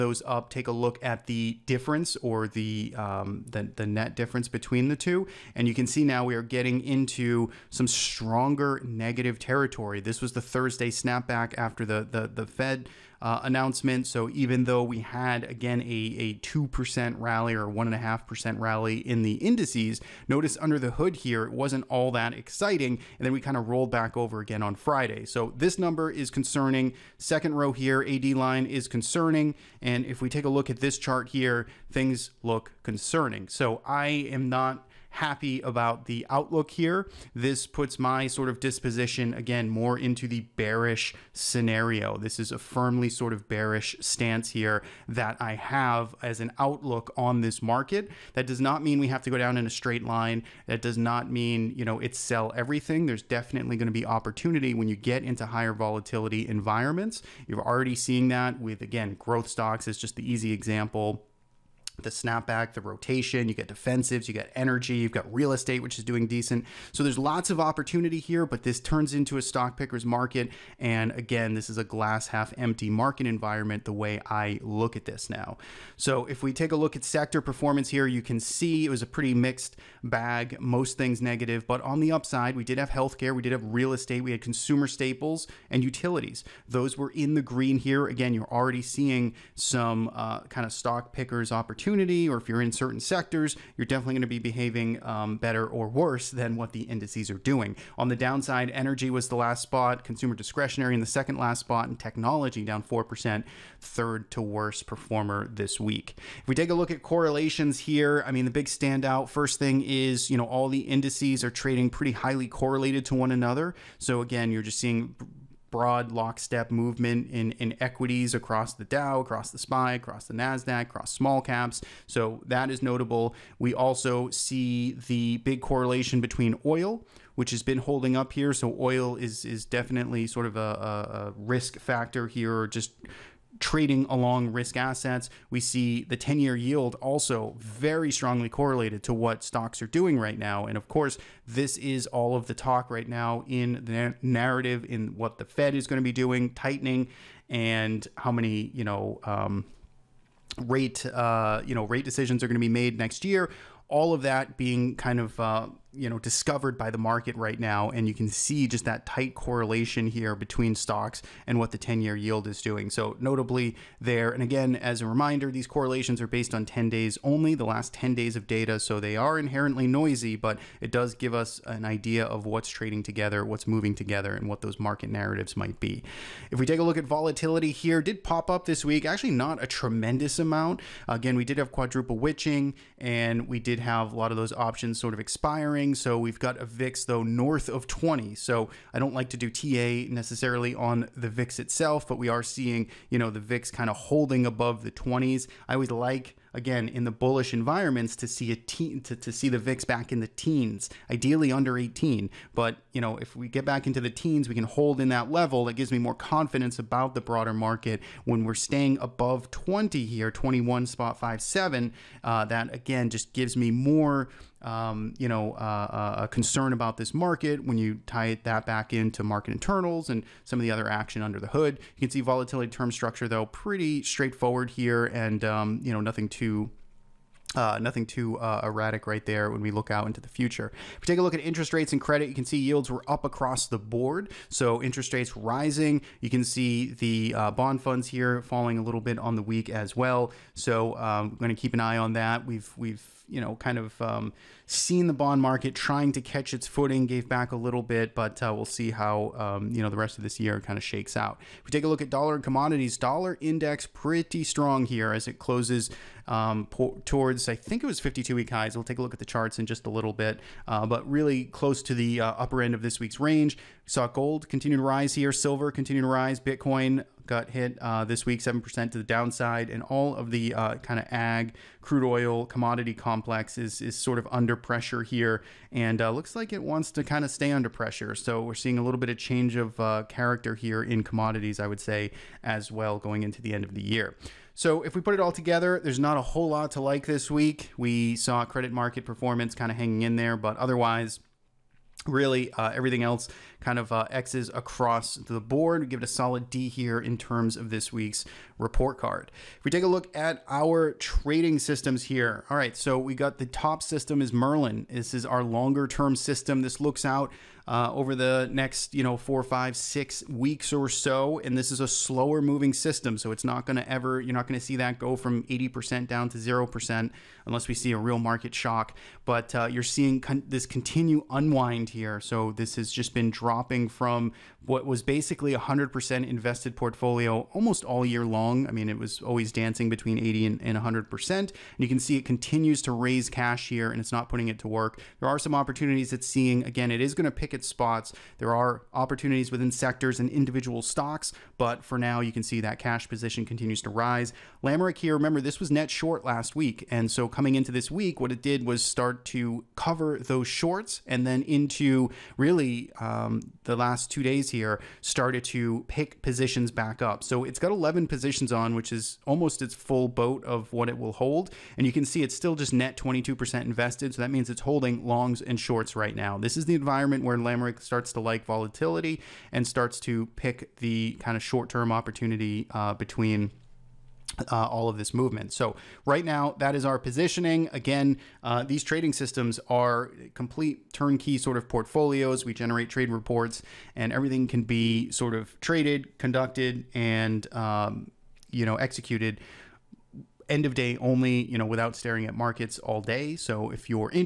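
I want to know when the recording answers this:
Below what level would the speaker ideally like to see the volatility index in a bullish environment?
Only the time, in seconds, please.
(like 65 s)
201 s.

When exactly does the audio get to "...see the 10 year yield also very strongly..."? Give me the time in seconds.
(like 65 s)
135 s.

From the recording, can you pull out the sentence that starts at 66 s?
So there's lots of opportunity here, but this turns into a stock picker's market.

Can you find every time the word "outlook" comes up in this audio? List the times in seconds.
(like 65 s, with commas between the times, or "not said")
36 s, 46 s.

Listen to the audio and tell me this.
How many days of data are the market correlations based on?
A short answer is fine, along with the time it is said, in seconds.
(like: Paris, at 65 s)
10 days, at 167 s.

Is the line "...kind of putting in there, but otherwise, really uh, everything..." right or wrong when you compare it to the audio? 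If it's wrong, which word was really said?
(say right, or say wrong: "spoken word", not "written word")
wrong: "hanging", not "putting".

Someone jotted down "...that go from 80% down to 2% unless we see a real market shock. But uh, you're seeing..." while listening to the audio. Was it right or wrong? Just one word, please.
wrong.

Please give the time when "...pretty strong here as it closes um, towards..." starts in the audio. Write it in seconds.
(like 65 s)
253 s.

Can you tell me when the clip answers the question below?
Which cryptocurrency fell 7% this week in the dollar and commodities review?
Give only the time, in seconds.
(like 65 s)
266 s.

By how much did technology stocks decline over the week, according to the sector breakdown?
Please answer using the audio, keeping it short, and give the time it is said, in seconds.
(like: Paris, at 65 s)
4%, at 101 s.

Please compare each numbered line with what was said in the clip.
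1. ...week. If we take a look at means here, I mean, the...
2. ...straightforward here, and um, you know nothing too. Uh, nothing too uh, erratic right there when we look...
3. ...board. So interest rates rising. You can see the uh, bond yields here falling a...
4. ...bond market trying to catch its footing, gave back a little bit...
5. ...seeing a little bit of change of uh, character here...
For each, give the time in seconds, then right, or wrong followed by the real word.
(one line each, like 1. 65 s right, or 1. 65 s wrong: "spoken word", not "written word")
1. 105 s wrong: "correlations", not "means"
2. 224 s right
3. 233 s wrong: "funds", not "yields"
4. 245 s right
5. 278 s right.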